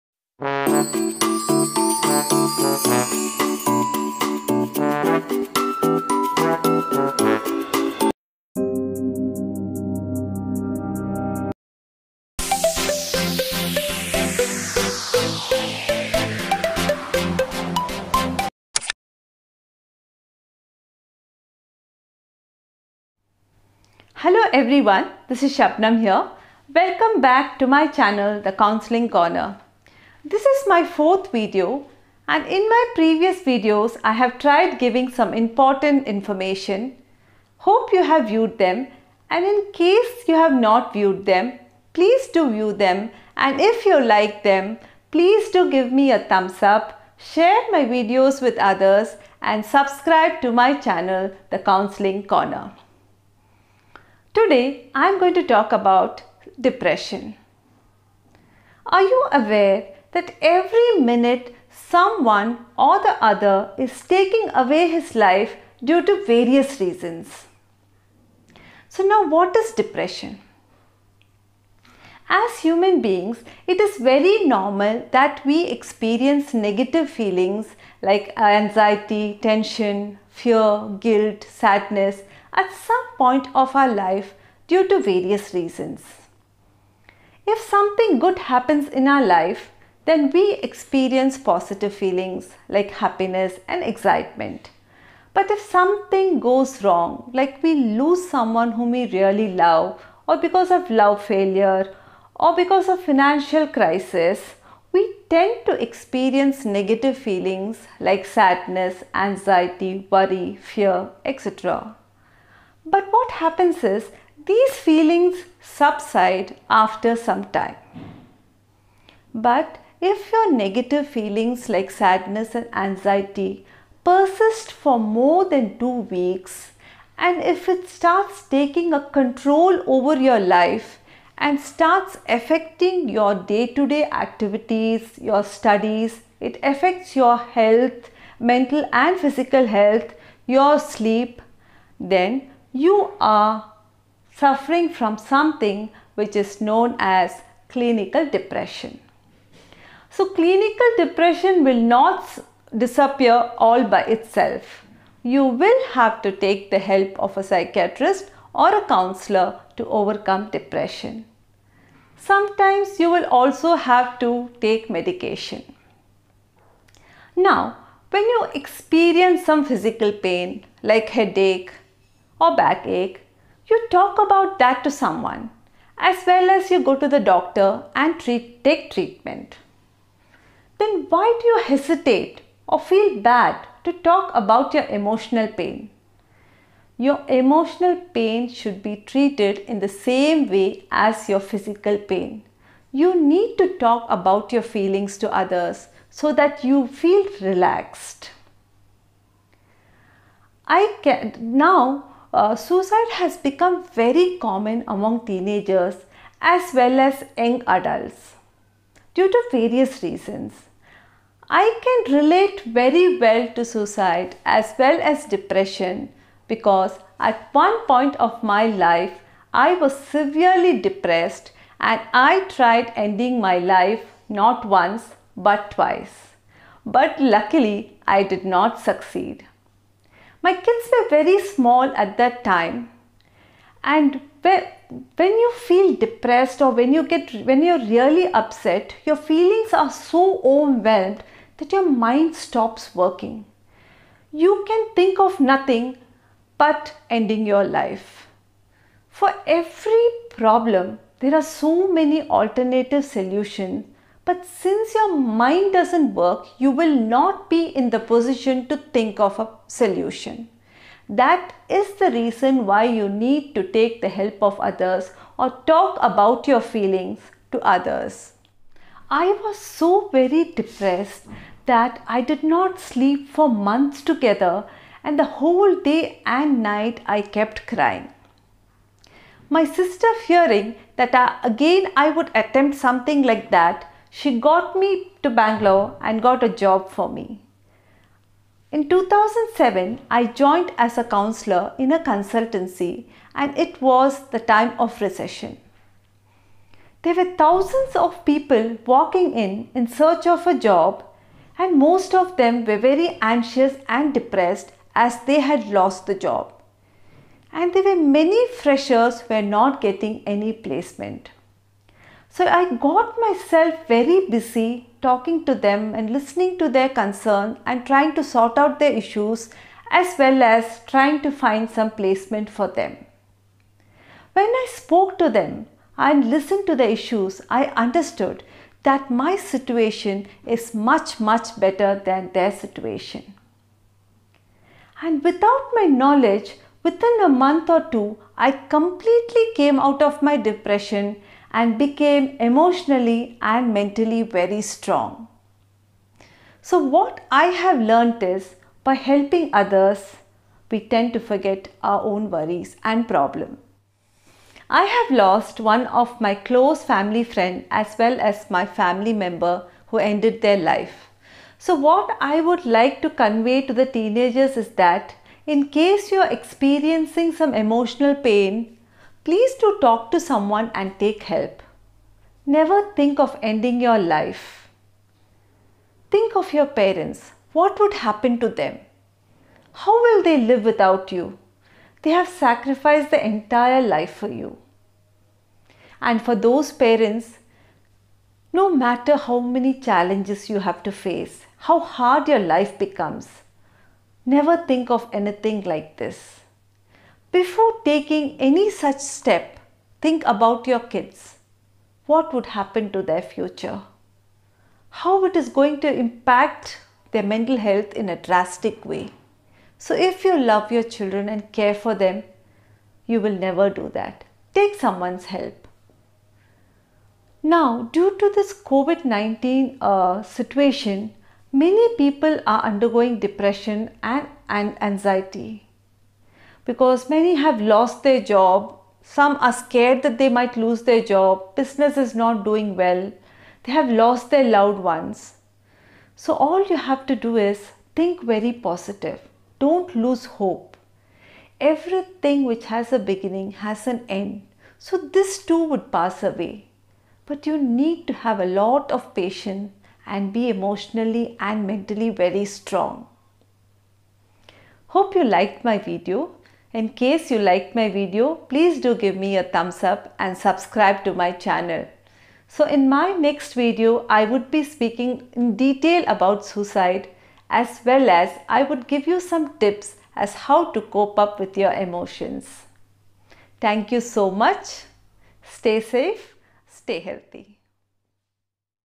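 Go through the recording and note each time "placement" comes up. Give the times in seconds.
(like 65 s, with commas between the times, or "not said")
310 s, 321 s.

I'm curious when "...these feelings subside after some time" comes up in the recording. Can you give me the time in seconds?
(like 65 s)
114 s.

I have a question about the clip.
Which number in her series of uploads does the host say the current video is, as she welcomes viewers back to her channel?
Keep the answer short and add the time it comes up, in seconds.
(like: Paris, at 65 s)
fourth, at 30 s.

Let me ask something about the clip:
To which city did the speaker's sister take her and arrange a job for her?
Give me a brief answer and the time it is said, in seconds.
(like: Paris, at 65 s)
Bangalore, at 285 s.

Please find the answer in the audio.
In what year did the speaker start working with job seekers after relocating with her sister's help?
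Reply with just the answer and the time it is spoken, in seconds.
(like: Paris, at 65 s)
2007, at 288 s.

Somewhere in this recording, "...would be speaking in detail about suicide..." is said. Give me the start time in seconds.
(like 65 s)
464 s.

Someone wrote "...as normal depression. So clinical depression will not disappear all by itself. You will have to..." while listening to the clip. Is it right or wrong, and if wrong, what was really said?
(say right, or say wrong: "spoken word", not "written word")
wrong: "clinical", not "normal".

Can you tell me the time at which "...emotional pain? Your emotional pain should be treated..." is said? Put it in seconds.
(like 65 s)
184 s.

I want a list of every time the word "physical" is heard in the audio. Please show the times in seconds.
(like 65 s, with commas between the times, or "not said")
139 s, 169 s, 191 s.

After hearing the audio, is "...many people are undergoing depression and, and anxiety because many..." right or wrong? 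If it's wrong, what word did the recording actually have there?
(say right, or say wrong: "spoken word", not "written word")
right.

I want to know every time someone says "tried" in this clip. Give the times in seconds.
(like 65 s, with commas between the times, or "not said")
34 s, 222 s.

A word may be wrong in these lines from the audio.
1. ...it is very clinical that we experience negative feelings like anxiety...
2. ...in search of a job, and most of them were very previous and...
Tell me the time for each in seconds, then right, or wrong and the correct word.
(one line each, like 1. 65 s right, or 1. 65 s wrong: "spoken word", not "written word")
1. 73 s wrong: "normal", not "clinical"
2. 299 s wrong: "anxious", not "previous".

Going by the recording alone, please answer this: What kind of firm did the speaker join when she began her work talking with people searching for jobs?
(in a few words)
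a consultancy.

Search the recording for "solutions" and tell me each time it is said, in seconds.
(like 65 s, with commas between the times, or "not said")
253 s, 259 s.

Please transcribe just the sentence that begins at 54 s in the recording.
Today I am going to talk about depression.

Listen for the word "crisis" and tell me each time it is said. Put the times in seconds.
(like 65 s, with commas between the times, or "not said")
103 s.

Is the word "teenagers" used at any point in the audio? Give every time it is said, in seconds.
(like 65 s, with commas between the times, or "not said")
205 s, 363 s.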